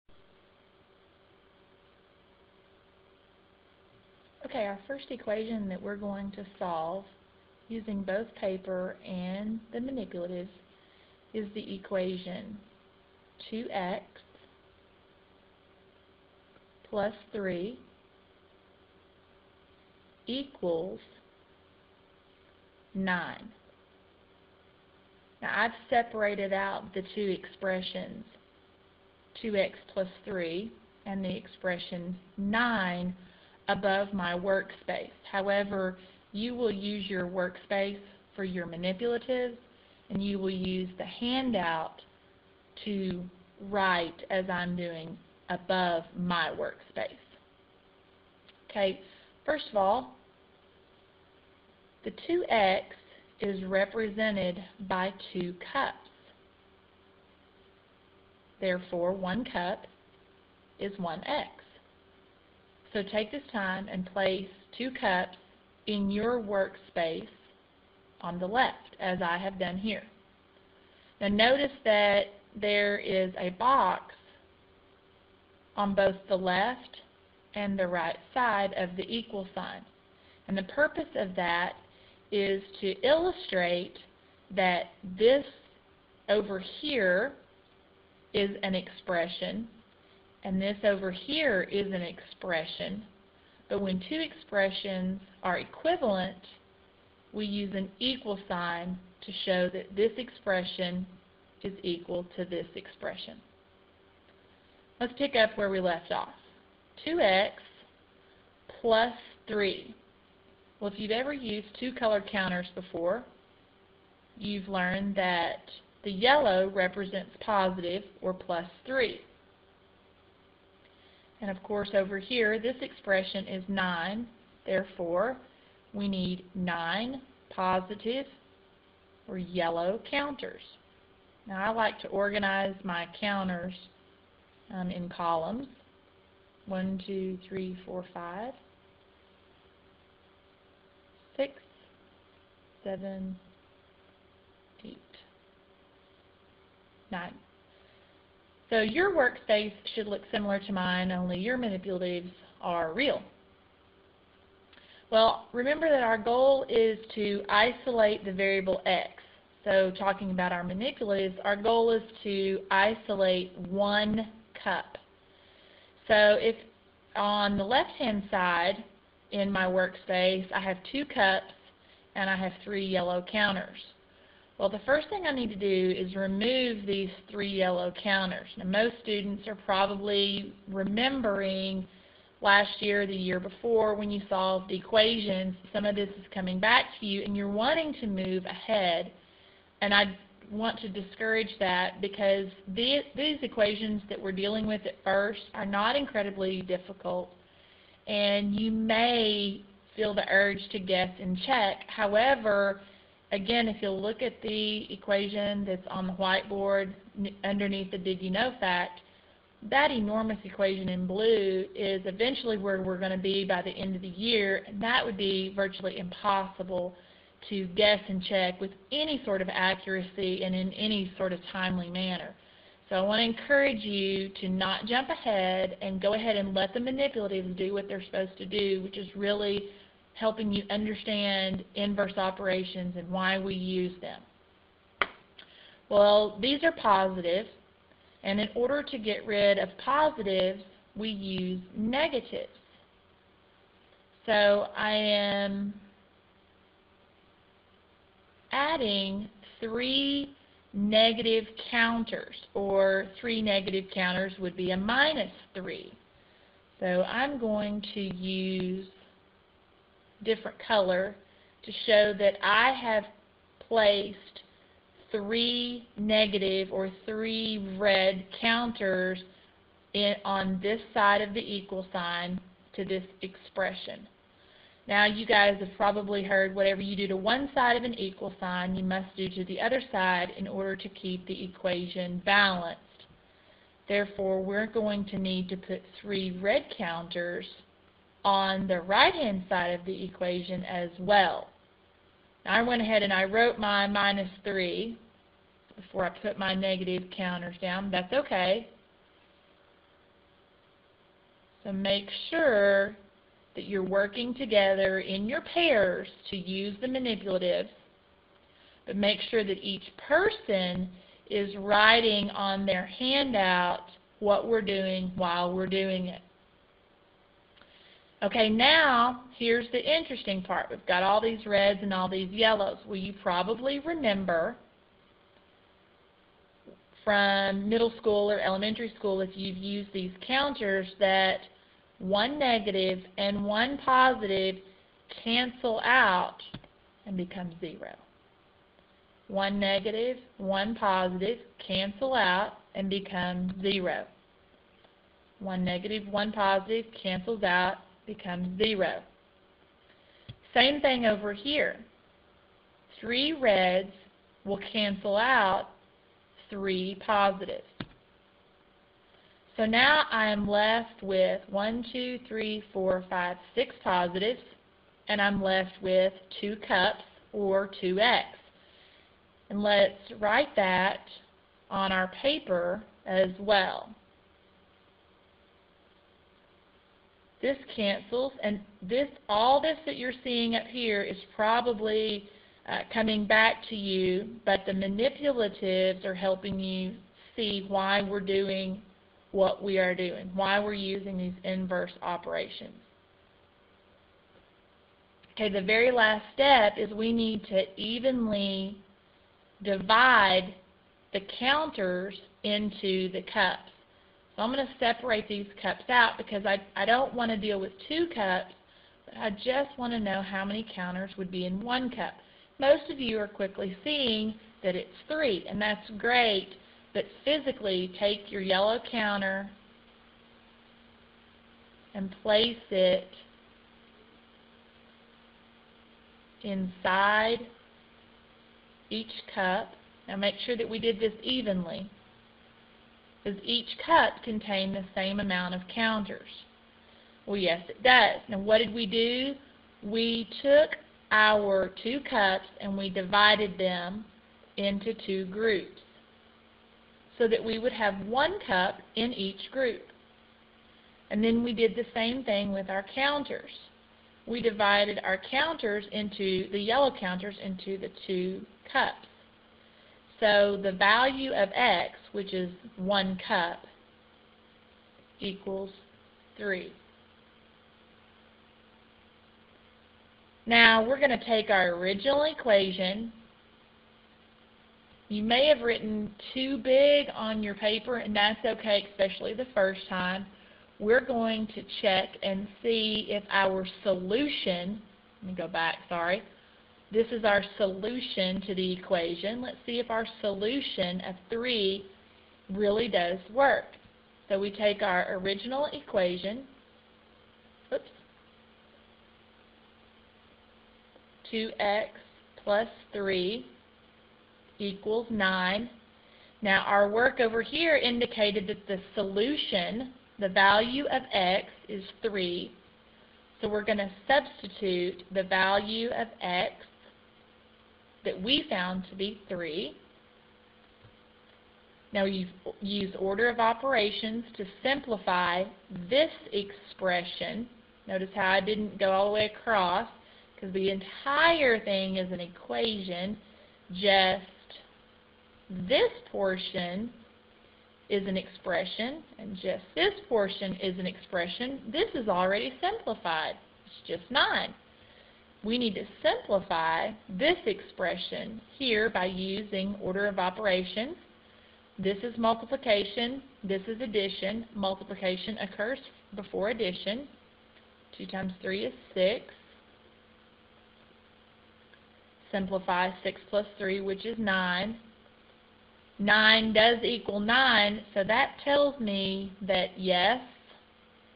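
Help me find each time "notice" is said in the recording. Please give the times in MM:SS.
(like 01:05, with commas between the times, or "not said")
01:11, 08:47.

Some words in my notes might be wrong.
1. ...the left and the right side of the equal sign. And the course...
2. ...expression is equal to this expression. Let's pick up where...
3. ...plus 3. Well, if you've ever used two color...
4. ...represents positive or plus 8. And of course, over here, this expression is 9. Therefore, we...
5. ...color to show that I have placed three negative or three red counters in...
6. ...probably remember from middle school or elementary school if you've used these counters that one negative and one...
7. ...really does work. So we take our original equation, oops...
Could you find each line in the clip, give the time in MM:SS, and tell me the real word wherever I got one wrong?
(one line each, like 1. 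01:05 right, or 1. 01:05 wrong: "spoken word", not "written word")
1. 01:16 wrong: "purpose", not "course"
2. 01:40 right
3. 01:48 right
4. 01:56 wrong: "3", not "8"
5. 04:20 right
6. 05:23 right
7. 08:12 right.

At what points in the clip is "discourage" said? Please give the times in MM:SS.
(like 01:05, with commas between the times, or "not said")
03:10.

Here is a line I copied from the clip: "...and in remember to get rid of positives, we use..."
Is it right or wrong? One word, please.
wrong.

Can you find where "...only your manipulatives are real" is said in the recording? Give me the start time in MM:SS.
02:31.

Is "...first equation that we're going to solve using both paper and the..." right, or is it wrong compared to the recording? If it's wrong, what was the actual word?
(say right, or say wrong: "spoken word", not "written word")
right.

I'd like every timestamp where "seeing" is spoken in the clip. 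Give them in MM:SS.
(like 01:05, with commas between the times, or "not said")
06:20, 06:53.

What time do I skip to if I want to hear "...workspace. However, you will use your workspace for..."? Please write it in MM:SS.
00:34.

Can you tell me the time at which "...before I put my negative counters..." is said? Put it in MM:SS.
04:55.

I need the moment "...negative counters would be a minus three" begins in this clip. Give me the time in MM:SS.
04:13.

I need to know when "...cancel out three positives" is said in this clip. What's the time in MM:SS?
05:54.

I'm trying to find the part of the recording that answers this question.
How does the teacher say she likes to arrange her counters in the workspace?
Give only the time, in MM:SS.
02:14.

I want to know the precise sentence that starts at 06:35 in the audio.
Okay, the very last step is we need to evenly divide the counters into the cups.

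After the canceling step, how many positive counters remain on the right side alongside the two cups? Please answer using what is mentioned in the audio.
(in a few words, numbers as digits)
6.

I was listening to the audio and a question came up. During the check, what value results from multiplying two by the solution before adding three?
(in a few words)
6.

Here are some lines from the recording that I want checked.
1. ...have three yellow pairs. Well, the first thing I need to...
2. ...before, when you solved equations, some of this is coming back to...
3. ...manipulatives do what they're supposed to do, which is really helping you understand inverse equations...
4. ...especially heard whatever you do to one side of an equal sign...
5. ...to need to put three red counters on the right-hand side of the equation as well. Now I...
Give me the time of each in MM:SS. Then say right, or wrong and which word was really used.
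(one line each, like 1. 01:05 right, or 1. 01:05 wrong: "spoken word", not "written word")
1. 02:52 wrong: "counters", not "pairs"
2. 03:03 right
3. 03:46 wrong: "operations", not "equations"
4. 04:35 wrong: "probably", not "especially"
5. 04:45 right.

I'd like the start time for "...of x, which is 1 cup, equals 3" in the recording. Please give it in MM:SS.
07:41.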